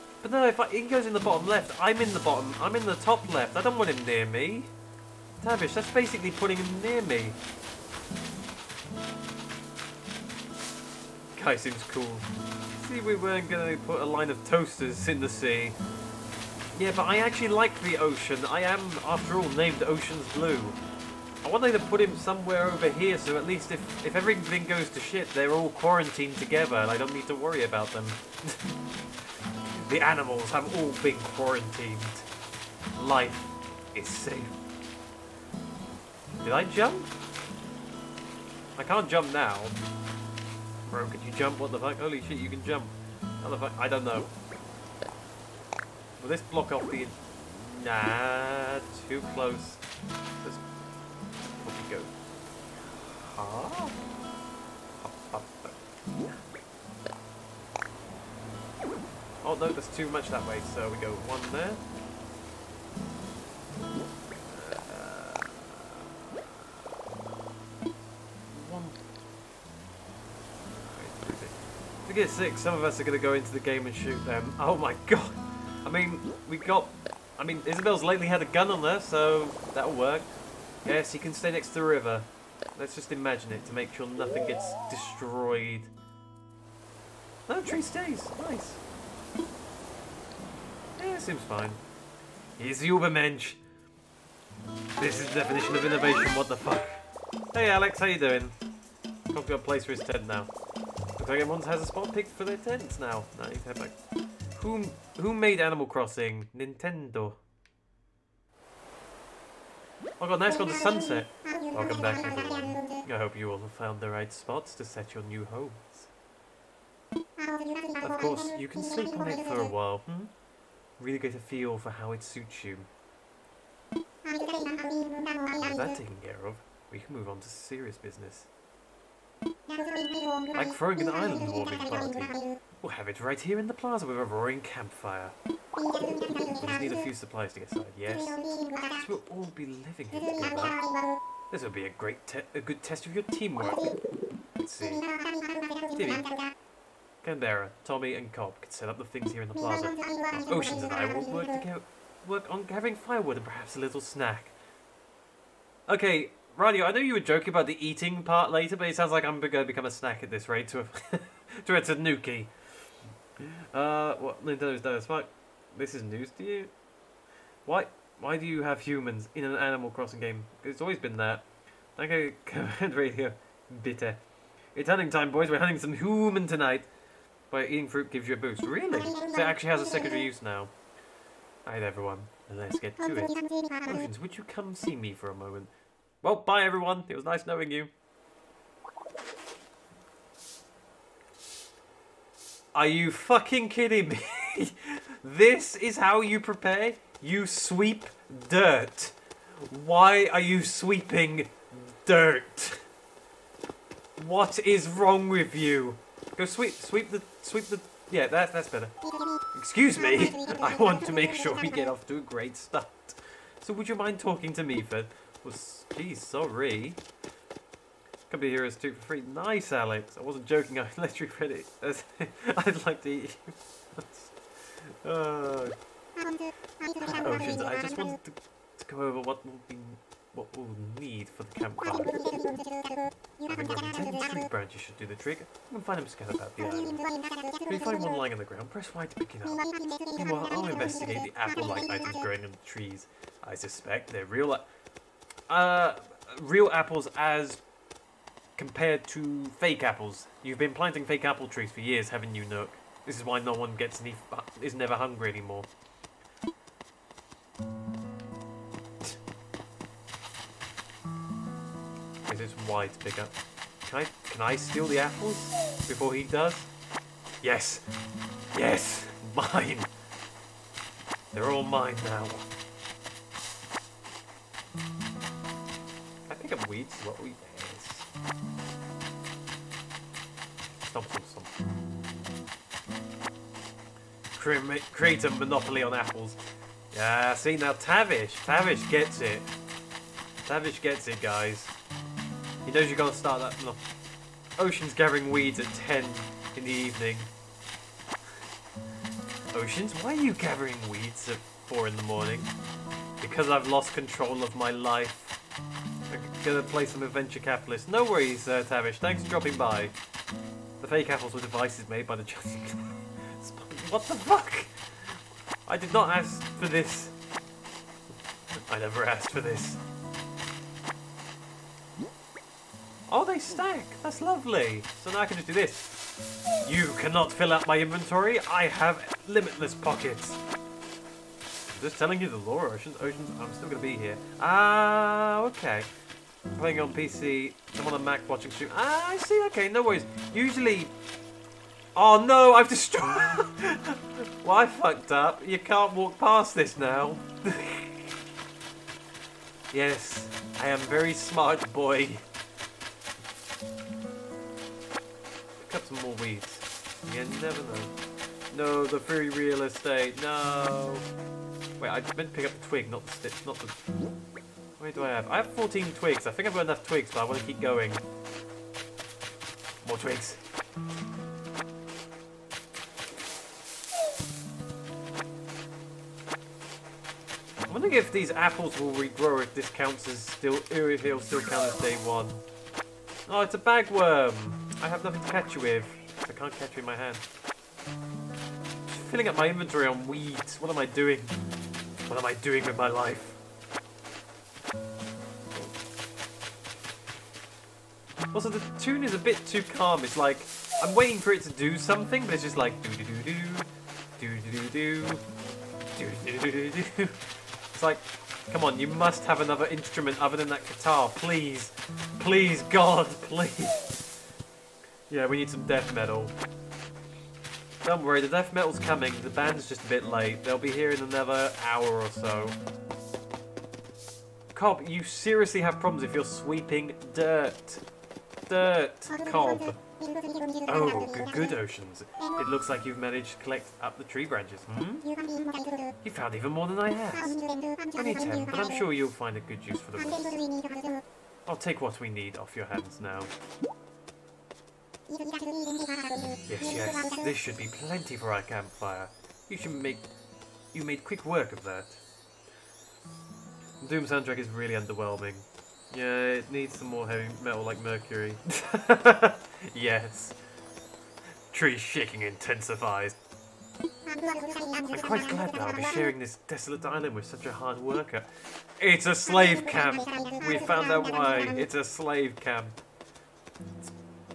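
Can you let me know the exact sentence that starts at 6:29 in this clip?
filling up my inventory on weeds.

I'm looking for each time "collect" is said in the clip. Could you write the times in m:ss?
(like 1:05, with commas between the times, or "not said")
7:13.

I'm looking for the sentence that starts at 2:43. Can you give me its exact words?
Uh, what Nintendo's done as fuck.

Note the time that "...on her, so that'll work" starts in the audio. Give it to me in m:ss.
1:18.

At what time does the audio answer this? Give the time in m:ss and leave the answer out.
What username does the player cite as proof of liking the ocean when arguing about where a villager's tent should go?
0:19.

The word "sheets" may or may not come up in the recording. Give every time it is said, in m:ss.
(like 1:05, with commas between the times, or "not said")
not said.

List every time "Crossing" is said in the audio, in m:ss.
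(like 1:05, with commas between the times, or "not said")
1:45, 2:49.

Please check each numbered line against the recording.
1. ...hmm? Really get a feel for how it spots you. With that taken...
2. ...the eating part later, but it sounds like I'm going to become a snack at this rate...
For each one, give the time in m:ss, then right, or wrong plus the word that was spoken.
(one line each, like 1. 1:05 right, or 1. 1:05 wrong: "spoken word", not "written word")
1. 1:59 wrong: "suits", not "spots"
2. 2:37 right.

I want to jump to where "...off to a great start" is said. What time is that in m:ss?
3:31.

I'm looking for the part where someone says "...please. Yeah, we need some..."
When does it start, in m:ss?
6:53.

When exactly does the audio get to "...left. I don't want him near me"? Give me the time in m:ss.
0:03.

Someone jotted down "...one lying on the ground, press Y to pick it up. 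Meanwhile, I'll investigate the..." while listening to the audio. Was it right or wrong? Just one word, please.
right.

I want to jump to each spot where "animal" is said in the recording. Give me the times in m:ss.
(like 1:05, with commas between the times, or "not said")
0:30, 1:45, 2:49.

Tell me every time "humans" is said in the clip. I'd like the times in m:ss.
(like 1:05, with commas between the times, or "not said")
2:48, 2:55.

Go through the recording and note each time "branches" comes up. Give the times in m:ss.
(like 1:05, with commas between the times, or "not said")
3:54, 7:14.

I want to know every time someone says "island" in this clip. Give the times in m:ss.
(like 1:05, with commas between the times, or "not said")
2:11, 3:56, 7:46.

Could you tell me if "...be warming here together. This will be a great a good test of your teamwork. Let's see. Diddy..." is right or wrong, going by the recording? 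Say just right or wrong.
wrong.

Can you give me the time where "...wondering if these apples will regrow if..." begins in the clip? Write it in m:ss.
6:17.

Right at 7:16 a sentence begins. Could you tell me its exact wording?
You found even more than I have.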